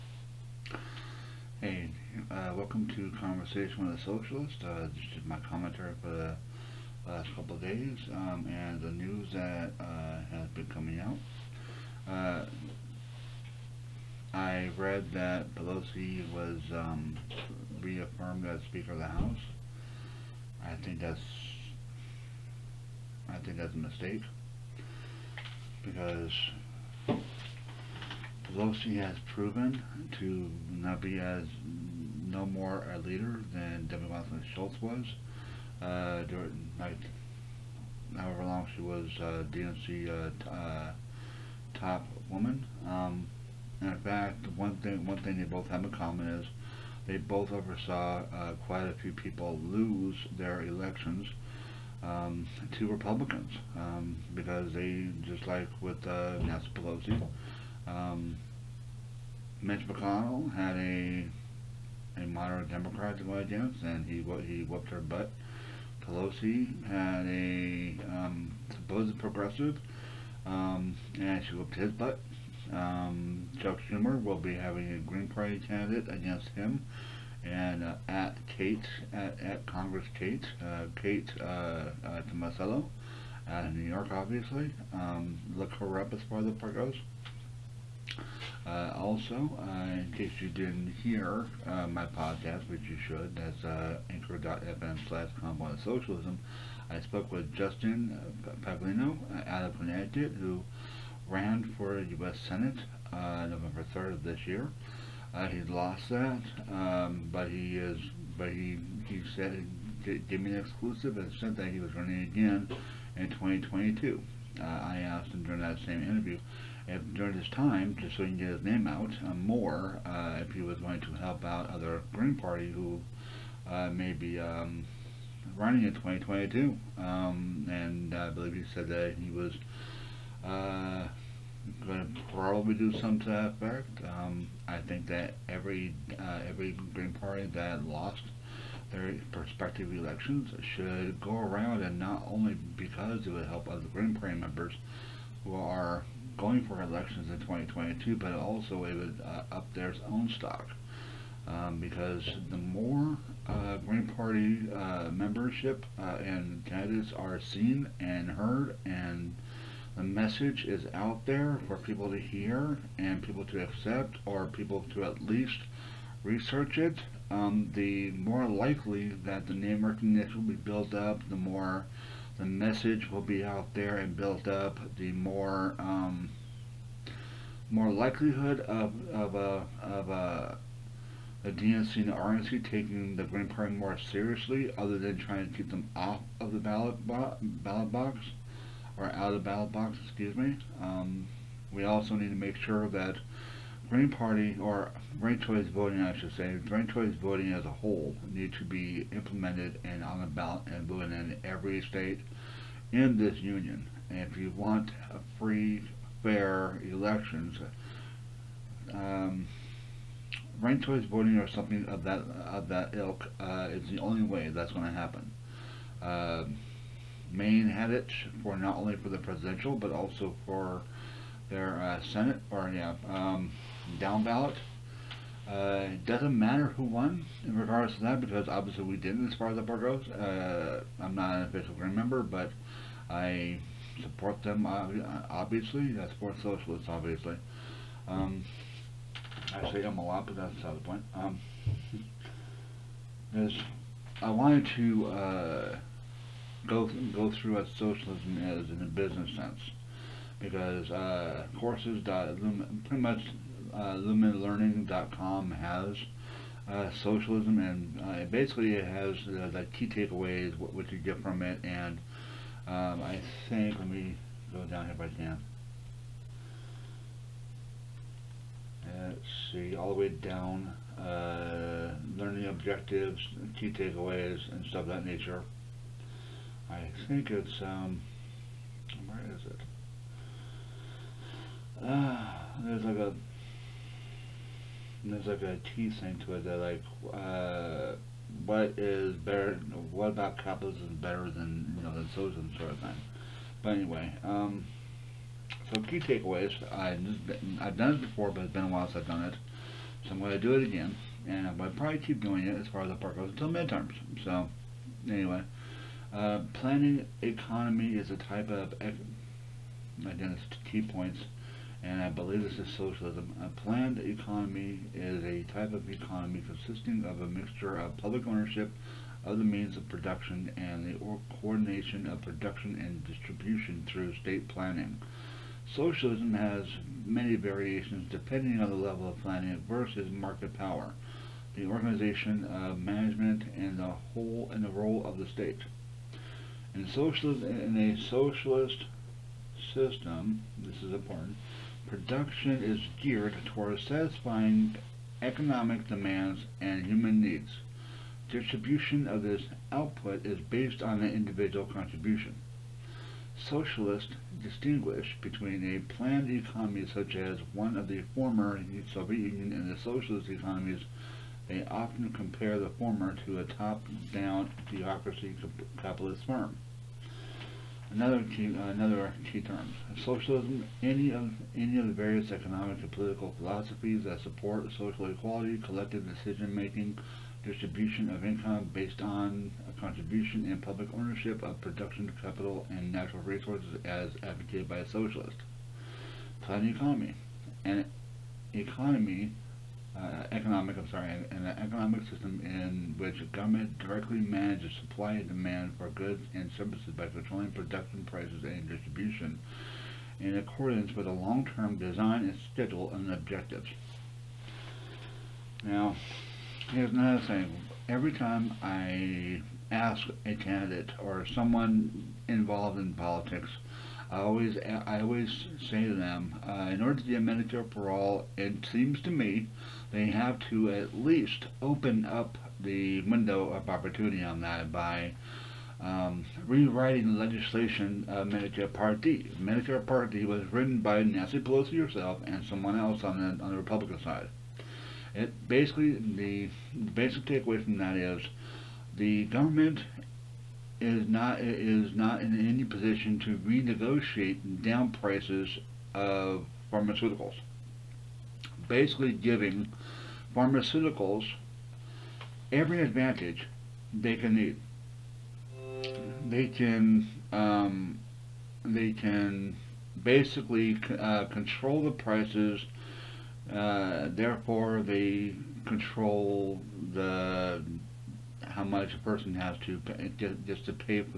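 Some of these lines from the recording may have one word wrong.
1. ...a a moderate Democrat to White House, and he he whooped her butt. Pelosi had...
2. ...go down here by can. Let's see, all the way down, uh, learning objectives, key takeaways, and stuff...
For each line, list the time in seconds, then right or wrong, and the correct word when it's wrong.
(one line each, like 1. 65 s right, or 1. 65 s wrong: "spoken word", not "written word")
1. 60 s right
2. 264 s right.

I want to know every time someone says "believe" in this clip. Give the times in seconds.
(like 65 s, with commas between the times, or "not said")
128 s, 312 s.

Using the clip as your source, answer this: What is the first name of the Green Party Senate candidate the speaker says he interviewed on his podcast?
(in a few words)
Justin.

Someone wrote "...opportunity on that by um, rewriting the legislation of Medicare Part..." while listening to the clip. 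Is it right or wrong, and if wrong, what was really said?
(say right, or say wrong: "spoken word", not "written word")
right.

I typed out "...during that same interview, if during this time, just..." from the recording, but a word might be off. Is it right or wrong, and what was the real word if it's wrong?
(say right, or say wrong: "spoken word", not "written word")
right.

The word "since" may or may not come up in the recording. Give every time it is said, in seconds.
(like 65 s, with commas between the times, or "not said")
298 s.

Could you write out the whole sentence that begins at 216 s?
Uh, Maine had it for not only for the presidential but also for their uh, Senate or yeah.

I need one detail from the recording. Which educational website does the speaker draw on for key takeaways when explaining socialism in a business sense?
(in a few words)
lumenlearning.com.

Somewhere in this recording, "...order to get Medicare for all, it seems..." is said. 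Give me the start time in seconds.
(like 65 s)
416 s.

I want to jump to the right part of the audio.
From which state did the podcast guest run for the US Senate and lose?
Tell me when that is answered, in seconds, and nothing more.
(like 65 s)
99 s.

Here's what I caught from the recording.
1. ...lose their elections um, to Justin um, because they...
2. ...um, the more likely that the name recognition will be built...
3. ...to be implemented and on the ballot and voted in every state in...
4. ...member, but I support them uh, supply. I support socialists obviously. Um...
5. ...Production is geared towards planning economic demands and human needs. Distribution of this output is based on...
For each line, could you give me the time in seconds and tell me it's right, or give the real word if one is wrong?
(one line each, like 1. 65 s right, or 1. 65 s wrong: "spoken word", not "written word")
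1. 49 s wrong: "Republicans", not "Justin"
2. 167 s right
3. 198 s right
4. 231 s wrong: "obviously", not "supply"
5. 341 s wrong: "satisfying", not "planning".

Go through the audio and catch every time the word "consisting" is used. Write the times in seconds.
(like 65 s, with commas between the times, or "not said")
316 s.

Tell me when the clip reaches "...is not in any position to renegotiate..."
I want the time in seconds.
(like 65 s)
441 s.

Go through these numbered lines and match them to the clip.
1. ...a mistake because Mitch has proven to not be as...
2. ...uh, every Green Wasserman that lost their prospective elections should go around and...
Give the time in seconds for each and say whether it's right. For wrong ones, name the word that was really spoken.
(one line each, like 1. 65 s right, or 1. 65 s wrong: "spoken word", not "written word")
1. 23 s wrong: "Pelosi", not "Mitch"
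2. 136 s wrong: "Party", not "Wasserman".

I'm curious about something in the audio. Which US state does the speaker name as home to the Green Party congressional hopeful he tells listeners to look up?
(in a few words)
New York.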